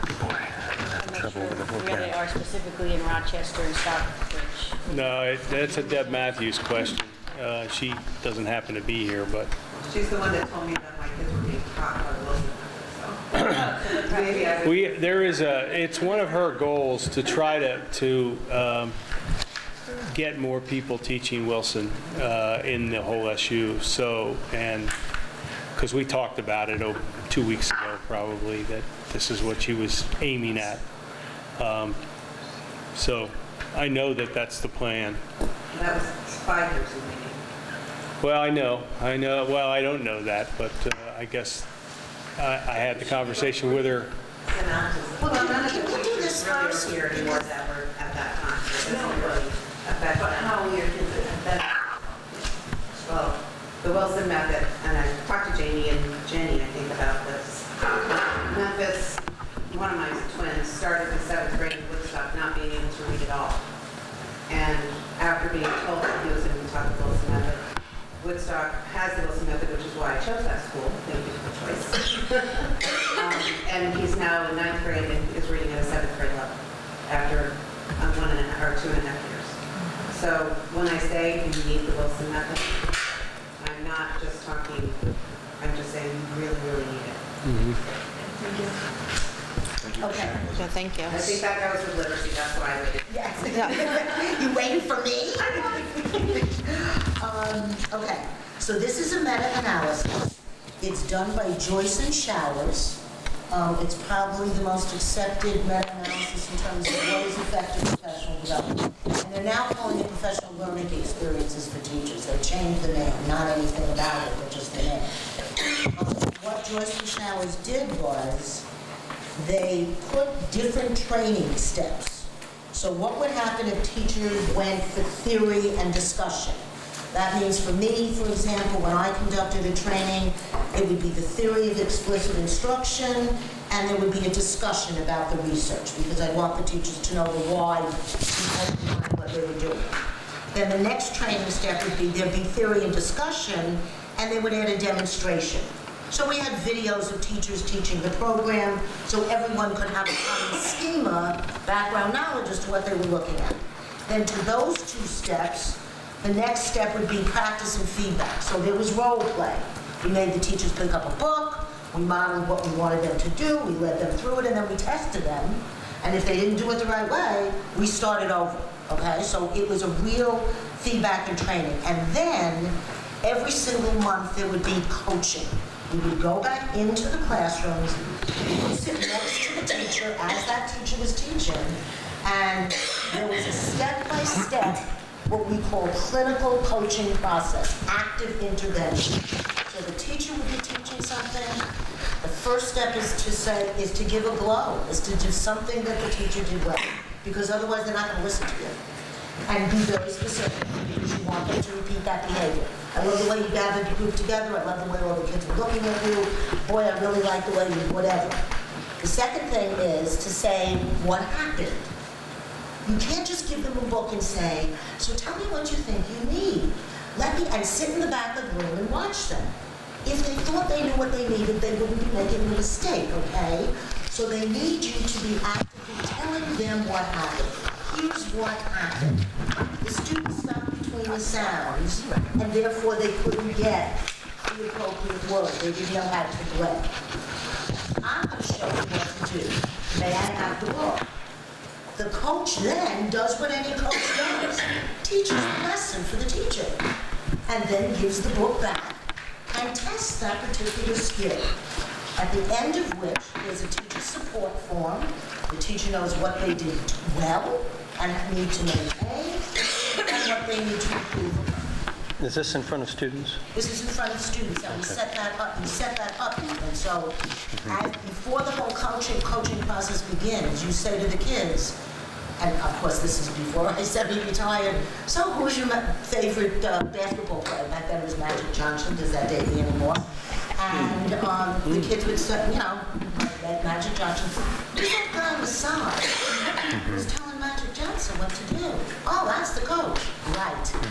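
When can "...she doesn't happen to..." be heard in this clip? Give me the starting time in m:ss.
0:07.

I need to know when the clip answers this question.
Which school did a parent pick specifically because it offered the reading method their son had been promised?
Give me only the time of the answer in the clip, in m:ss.
1:08.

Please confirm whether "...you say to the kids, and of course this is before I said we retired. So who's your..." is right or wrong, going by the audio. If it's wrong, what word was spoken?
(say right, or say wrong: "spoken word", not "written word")
right.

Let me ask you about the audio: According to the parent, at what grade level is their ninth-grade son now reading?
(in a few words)
7th grade.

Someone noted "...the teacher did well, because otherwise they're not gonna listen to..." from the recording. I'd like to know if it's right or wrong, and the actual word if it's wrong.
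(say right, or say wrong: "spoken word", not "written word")
right.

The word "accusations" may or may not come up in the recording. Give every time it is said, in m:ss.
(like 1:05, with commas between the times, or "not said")
not said.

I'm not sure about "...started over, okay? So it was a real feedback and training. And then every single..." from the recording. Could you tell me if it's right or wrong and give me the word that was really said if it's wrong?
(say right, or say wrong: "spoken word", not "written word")
right.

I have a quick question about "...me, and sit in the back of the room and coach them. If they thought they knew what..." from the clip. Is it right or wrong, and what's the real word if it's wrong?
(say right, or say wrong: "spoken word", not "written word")
wrong: "watch", not "coach".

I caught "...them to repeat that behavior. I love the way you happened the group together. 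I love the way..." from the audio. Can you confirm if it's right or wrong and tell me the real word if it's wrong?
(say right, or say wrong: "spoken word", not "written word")
wrong: "gathered", not "happened".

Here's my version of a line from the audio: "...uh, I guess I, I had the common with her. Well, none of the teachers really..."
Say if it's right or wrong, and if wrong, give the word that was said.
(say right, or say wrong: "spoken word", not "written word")
wrong: "conversation", not "common".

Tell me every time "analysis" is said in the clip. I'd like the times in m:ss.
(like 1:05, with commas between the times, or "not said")
1:39, 1:45.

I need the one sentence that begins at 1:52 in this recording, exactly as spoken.
They changed the name, not anything about it, but just the name.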